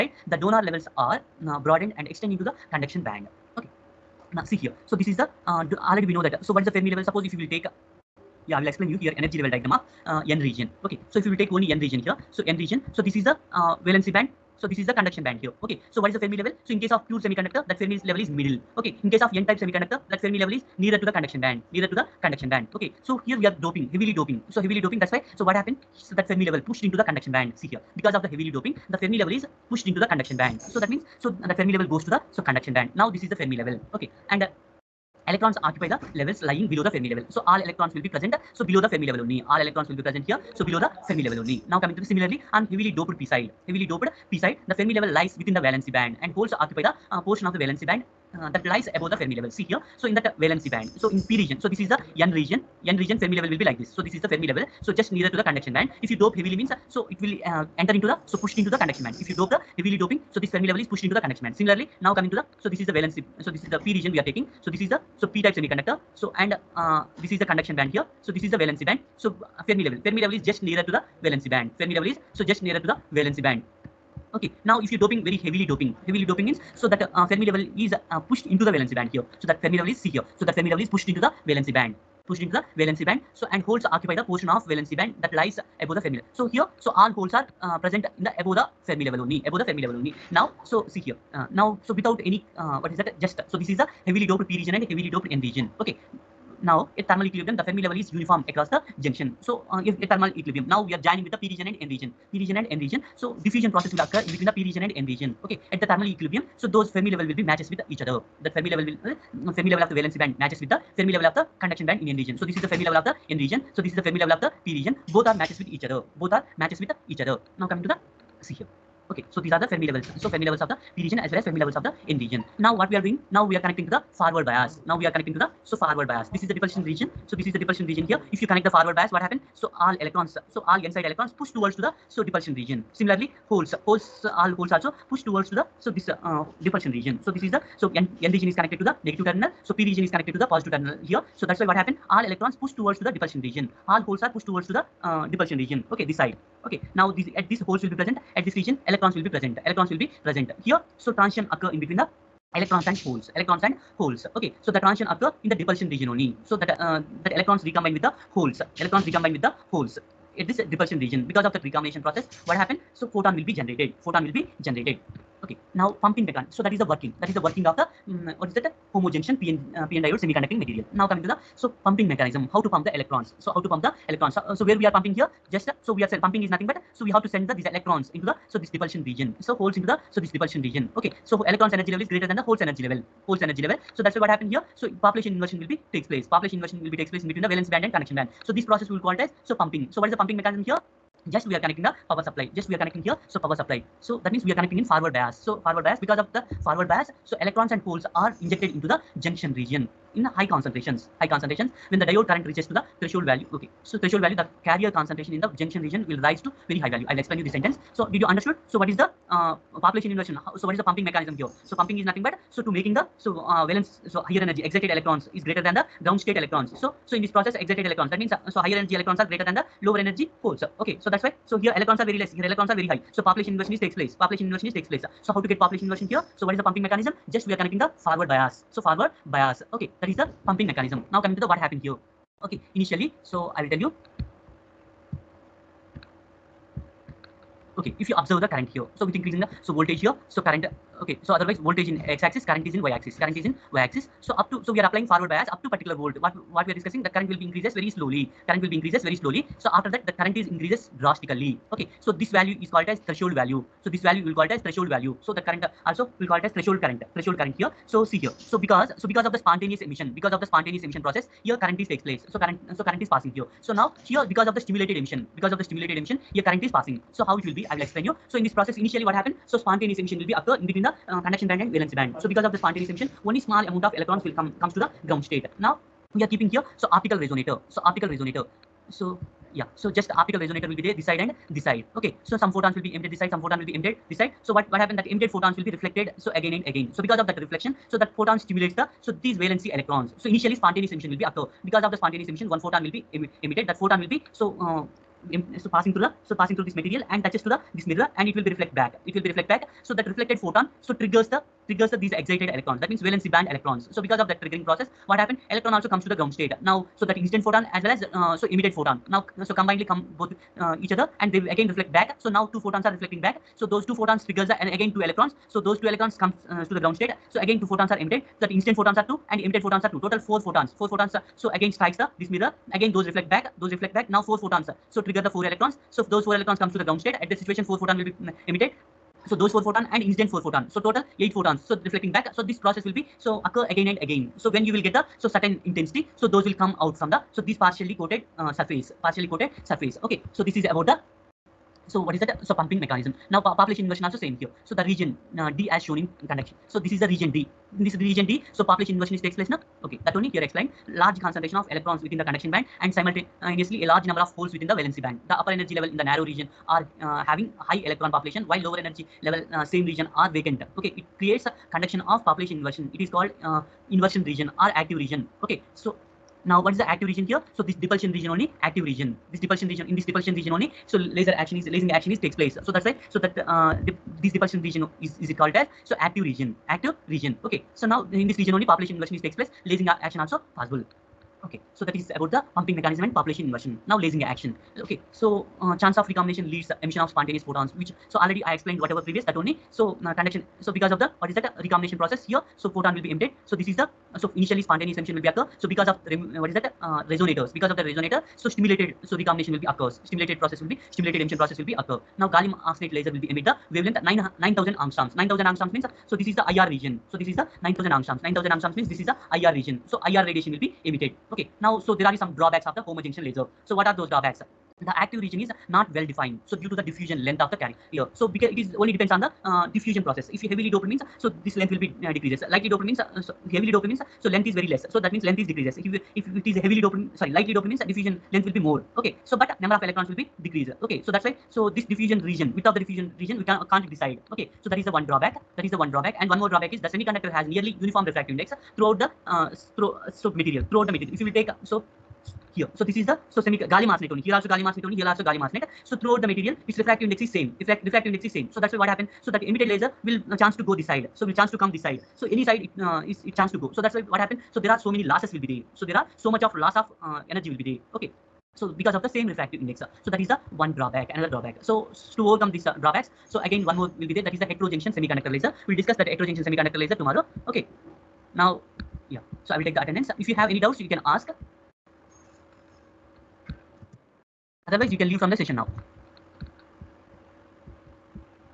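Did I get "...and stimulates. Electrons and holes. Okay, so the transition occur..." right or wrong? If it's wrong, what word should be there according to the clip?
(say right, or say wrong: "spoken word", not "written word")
wrong: "holes", not "stimulates".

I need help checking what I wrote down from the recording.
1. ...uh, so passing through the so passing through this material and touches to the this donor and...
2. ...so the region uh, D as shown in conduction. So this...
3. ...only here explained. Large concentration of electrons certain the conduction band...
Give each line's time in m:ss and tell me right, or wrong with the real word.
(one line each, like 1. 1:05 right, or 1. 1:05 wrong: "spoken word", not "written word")
1. 4:54 wrong: "mirror", not "donor"
2. 5:44 right
3. 5:50 wrong: "within", not "certain".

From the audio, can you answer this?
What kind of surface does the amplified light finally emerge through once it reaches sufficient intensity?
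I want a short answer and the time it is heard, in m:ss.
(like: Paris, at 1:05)
partially coated surface, at 5:39.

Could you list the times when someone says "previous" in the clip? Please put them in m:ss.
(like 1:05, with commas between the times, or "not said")
6:29.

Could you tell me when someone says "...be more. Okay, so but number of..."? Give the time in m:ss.
7:08.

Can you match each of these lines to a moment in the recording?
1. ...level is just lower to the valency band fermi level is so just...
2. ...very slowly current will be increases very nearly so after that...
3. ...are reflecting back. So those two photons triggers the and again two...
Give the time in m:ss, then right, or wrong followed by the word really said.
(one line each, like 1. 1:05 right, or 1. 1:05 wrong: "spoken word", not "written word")
1. 1:10 wrong: "nearer", not "lower"
2. 4:07 wrong: "slowly", not "nearly"
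3. 5:12 right.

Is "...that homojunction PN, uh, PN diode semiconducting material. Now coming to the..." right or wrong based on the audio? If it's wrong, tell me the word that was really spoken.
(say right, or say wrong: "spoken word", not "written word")
right.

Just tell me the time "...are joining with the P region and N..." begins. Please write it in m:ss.
1:40.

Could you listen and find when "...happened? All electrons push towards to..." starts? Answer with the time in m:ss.
2:21.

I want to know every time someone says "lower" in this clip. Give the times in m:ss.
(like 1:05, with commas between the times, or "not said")
3:39, 5:58.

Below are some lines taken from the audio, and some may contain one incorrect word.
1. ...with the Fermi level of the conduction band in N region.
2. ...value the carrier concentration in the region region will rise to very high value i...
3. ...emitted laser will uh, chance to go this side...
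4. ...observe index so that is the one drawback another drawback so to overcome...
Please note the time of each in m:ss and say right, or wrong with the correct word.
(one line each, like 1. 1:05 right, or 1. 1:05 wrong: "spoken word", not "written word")
1. 1:50 right
2. 3:24 wrong: "junction", not "region"
3. 7:29 right
4. 7:39 wrong: "refractive", not "observe".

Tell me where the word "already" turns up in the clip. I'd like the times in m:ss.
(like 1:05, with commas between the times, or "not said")
0:05, 6:28.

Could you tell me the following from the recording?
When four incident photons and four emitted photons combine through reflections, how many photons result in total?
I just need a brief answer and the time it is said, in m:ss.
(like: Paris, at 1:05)
8, at 5:31.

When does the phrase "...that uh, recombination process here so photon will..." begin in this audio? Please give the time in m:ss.
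6:31.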